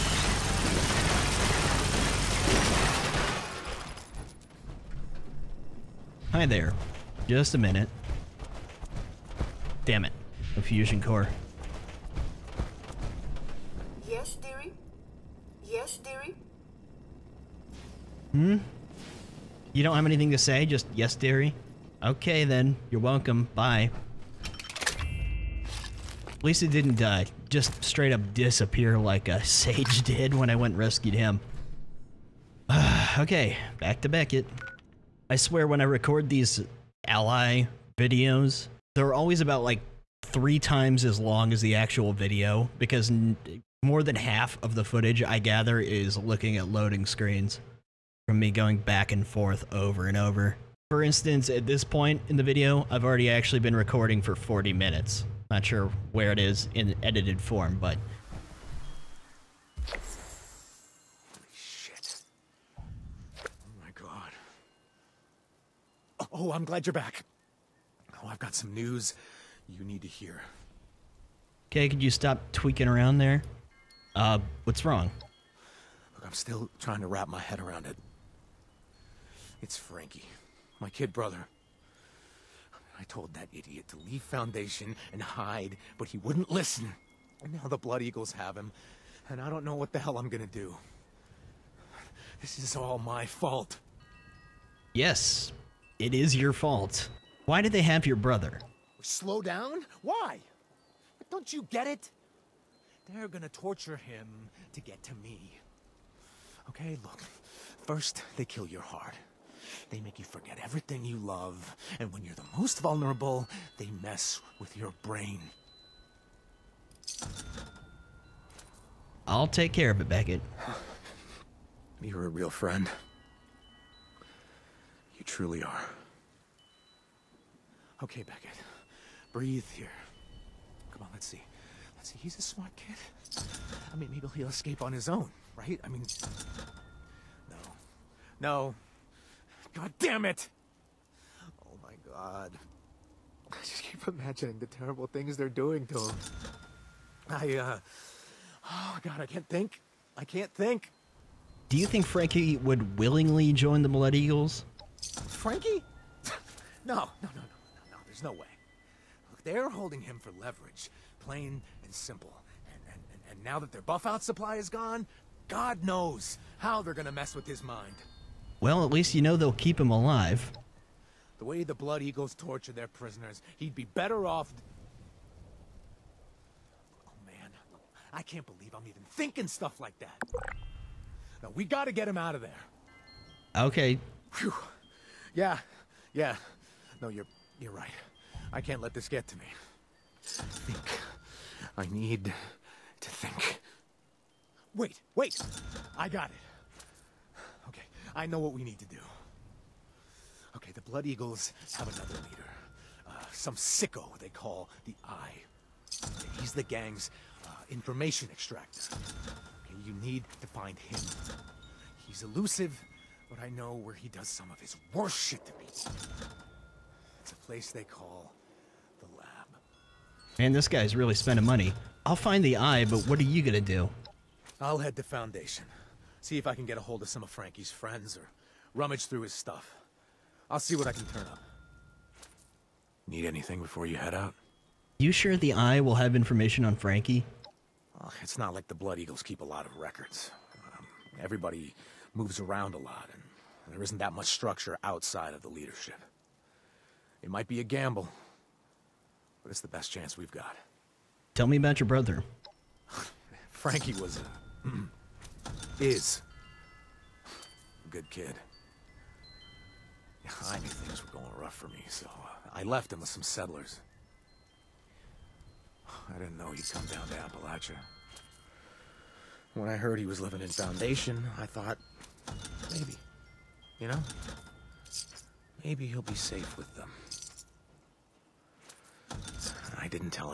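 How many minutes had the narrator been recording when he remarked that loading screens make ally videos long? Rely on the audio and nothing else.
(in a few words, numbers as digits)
40.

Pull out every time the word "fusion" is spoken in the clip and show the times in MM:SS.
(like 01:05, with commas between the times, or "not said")
00:10.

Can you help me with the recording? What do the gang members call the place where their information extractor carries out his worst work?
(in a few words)
the lab.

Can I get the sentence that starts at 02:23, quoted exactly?
I just keep imagining the terrible things they're doing to him.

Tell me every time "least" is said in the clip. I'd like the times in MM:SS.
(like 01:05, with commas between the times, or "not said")
00:26, 02:48.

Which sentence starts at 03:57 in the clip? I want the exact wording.
Well, it's not like the Blood Eagles keep a lot of records.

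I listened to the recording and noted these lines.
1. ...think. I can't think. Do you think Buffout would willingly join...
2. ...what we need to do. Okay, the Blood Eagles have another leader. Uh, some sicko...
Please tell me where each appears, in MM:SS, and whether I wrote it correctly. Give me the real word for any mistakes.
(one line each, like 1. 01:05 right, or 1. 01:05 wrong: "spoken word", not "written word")
1. 02:29 wrong: "Frankie", not "Buffout"
2. 03:18 right.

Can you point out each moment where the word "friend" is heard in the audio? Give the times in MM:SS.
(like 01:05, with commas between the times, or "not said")
02:02, 03:47.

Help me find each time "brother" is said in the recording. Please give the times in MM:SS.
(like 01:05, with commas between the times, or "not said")
01:21, 01:38, 04:11.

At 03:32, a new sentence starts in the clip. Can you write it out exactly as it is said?
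He's elusive, but I know where he does some of his worst shit to me.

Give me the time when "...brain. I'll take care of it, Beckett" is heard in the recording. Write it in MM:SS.
01:55.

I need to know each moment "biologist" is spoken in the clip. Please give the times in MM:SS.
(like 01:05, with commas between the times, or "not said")
not said.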